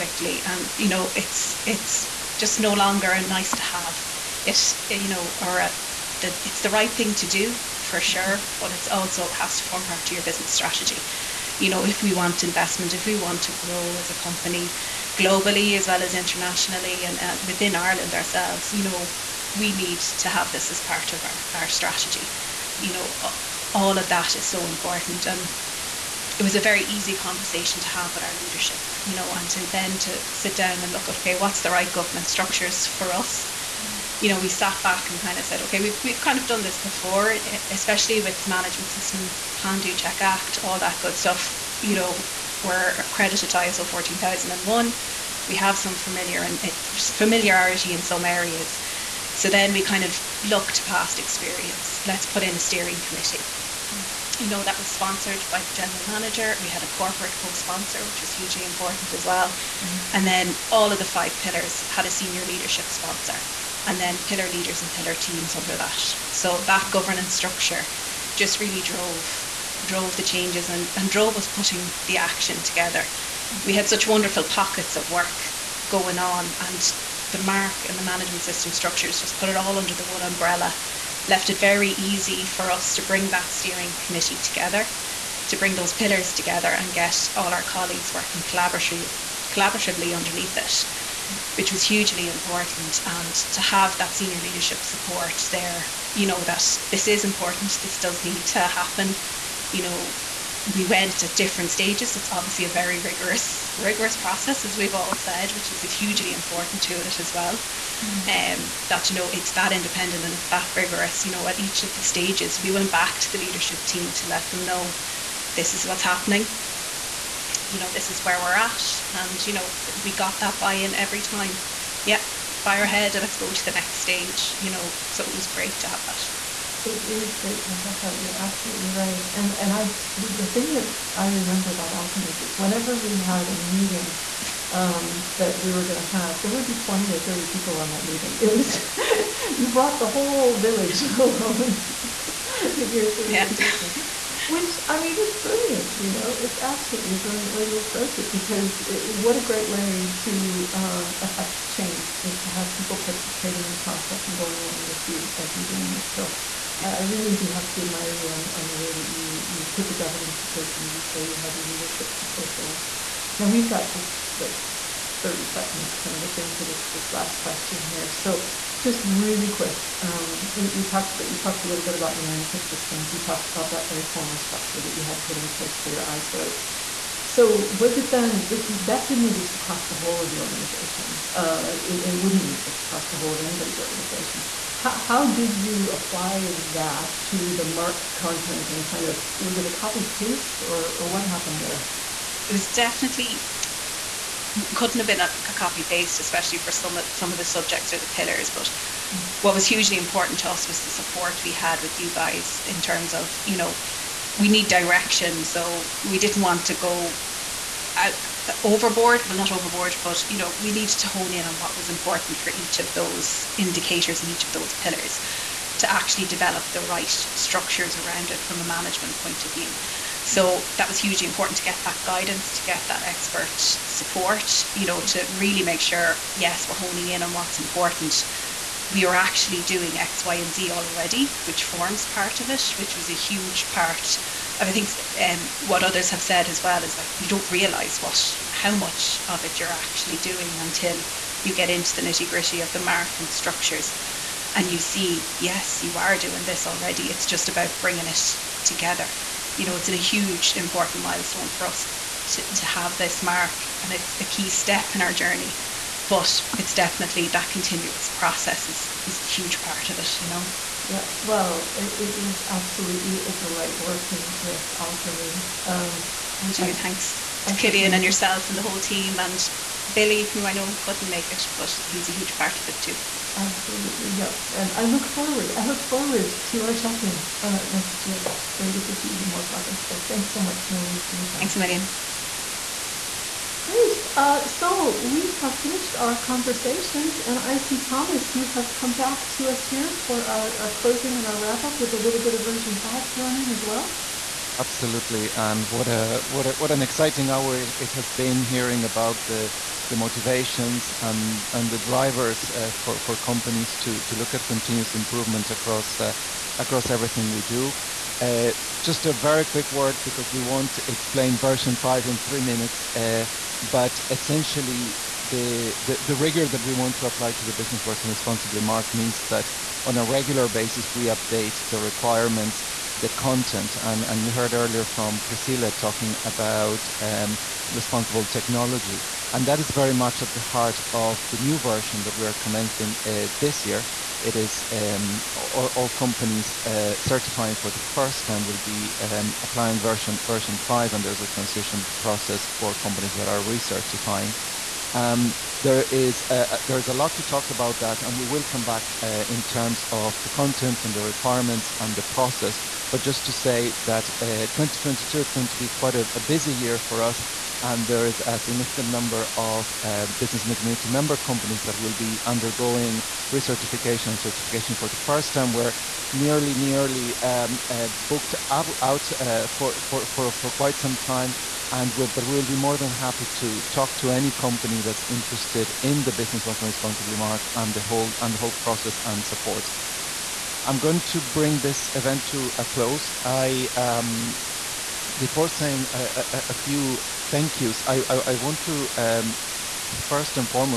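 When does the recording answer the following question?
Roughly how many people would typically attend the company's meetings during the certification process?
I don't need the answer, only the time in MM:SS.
02:16.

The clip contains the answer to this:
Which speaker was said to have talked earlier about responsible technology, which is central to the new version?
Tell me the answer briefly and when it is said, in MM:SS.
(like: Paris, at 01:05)
Priscilla, at 05:25.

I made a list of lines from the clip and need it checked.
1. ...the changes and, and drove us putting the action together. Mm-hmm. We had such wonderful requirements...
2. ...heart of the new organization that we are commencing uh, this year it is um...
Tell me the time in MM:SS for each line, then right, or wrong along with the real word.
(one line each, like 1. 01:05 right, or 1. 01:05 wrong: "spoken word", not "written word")
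1. 01:10 wrong: "pockets", not "requirements"
2. 05:30 wrong: "version", not "organization".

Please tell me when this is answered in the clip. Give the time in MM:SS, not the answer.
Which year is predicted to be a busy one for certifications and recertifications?
05:54.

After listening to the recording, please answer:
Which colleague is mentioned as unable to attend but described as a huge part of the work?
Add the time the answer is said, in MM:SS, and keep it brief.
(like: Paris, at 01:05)
Billy, at 04:29.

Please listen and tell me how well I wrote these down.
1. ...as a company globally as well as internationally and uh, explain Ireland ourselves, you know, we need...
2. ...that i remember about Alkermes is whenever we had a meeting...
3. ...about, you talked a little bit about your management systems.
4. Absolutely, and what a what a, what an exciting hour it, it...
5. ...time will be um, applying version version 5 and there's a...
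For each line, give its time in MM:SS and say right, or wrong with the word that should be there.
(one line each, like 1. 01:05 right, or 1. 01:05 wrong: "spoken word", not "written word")
1. 00:13 wrong: "within", not "explain"
2. 02:10 right
3. 02:51 right
4. 04:54 right
5. 05:38 right.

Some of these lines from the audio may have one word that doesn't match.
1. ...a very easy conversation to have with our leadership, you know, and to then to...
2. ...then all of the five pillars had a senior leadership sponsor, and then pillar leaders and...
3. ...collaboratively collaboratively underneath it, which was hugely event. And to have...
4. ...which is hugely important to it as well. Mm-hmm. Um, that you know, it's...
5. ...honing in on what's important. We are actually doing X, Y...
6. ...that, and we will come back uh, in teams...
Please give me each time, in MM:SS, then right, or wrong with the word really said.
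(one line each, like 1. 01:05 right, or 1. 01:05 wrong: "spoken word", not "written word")
1. 00:26 right
2. 01:00 right
3. 01:28 wrong: "important", not "event"
4. 01:45 right
5. 03:46 right
6. 05:47 wrong: "terms", not "teams".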